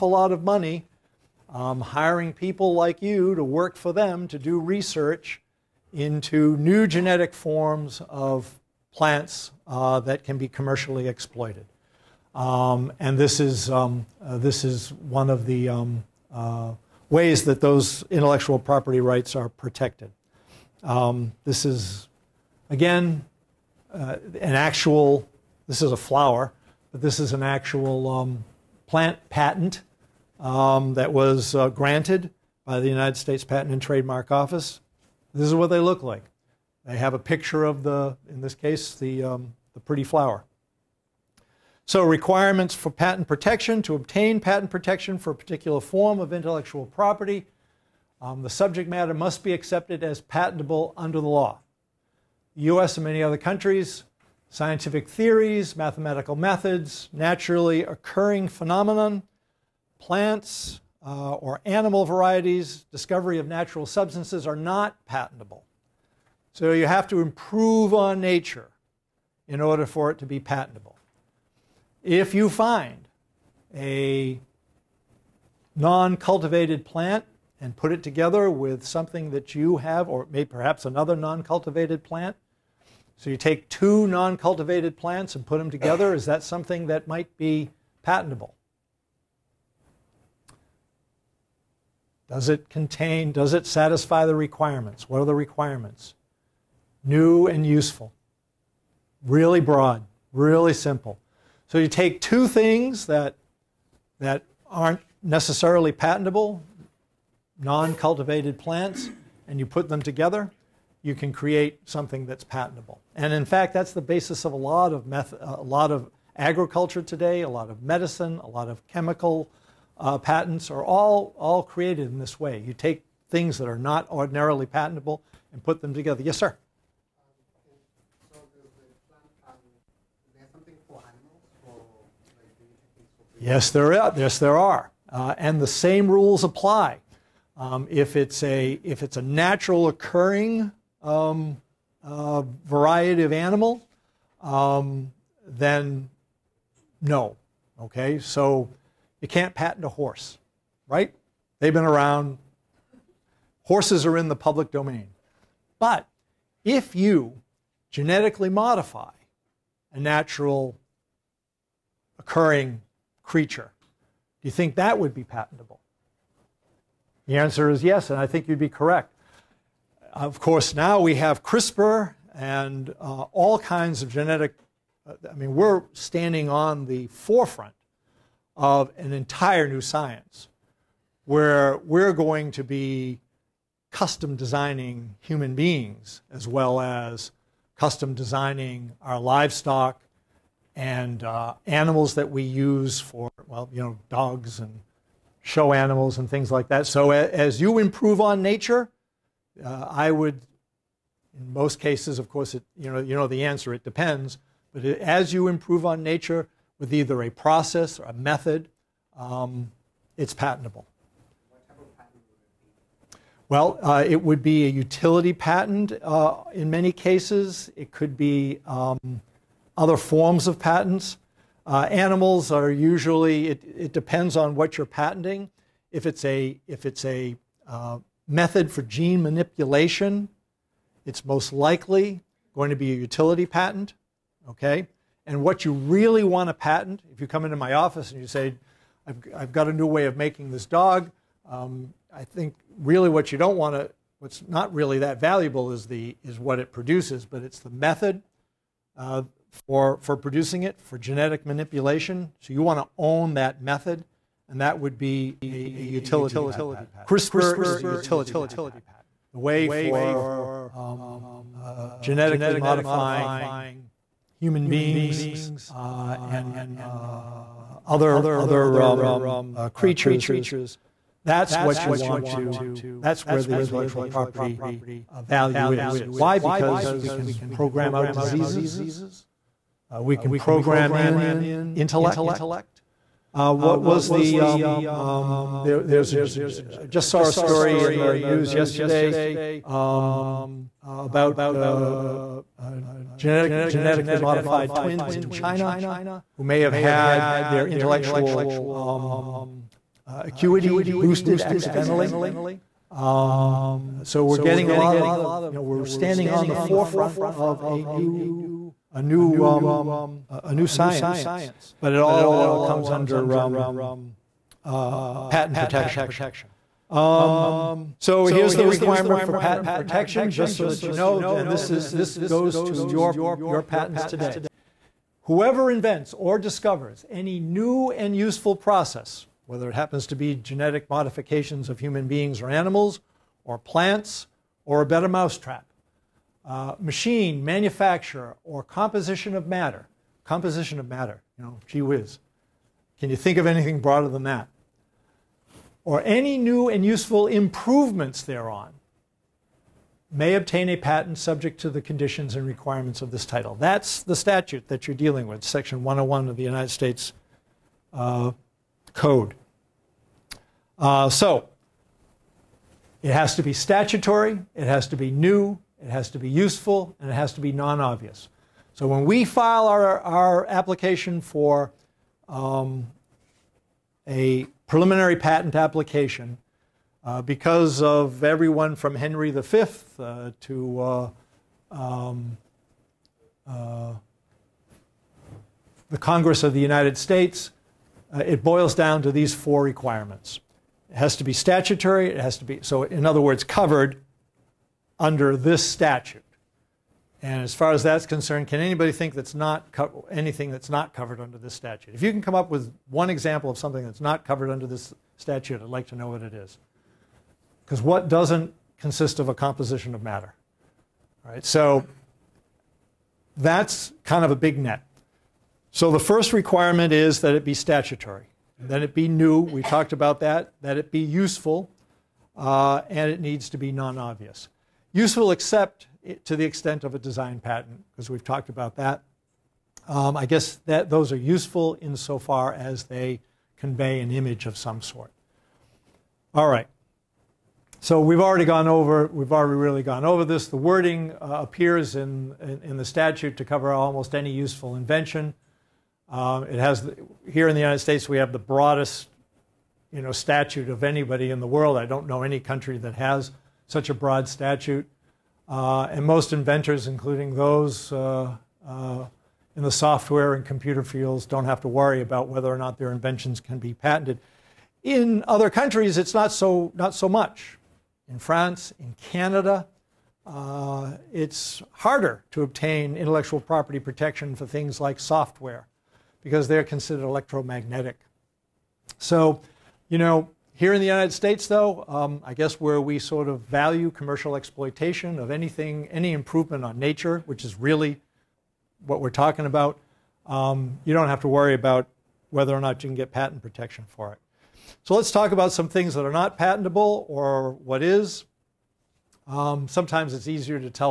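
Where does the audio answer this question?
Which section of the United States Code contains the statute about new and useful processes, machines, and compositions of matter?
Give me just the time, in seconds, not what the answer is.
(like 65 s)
355 s.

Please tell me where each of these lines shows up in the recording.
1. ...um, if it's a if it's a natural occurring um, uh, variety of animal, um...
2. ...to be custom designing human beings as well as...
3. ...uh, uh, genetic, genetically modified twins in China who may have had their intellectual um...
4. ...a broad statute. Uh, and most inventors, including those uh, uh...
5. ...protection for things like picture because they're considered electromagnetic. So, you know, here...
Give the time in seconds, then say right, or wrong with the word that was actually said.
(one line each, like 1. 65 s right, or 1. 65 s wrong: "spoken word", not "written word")
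1. 137 s right
2. 182 s right
3. 291 s right
4. 453 s right
5. 473 s wrong: "software", not "picture".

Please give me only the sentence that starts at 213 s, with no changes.
Well, uh, it would be a utility patent uh, in many cases.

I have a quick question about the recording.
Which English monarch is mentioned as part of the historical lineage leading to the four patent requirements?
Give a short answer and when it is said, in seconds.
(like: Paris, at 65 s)
Henry V, at 378 s.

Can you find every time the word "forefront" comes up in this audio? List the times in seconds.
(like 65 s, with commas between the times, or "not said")
177 s, 306 s.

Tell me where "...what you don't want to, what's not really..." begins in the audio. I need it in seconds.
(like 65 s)
243 s.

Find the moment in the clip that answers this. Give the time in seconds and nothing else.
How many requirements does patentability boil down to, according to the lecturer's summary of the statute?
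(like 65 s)
389 s.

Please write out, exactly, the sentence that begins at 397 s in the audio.
And as far as that's concerned, can anybody think that's not anything that's not covered under this statute?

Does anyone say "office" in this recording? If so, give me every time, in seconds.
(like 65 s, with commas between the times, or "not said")
34 s, 237 s.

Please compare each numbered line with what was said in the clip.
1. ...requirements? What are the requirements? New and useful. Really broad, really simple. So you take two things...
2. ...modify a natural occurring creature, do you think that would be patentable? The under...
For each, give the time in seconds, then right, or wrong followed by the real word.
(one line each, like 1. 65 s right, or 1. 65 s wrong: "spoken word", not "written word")
1. 94 s right
2. 158 s wrong: "answer", not "under".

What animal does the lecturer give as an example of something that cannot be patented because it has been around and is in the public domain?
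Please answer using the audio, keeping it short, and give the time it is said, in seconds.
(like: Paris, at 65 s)
horse, at 149 s.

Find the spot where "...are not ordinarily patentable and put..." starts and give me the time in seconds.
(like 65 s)
123 s.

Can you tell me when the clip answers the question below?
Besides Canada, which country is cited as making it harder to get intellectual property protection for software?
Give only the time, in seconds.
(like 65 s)
468 s.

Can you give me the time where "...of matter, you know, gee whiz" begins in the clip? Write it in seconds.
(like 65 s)
340 s.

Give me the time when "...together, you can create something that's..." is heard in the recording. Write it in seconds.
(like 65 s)
110 s.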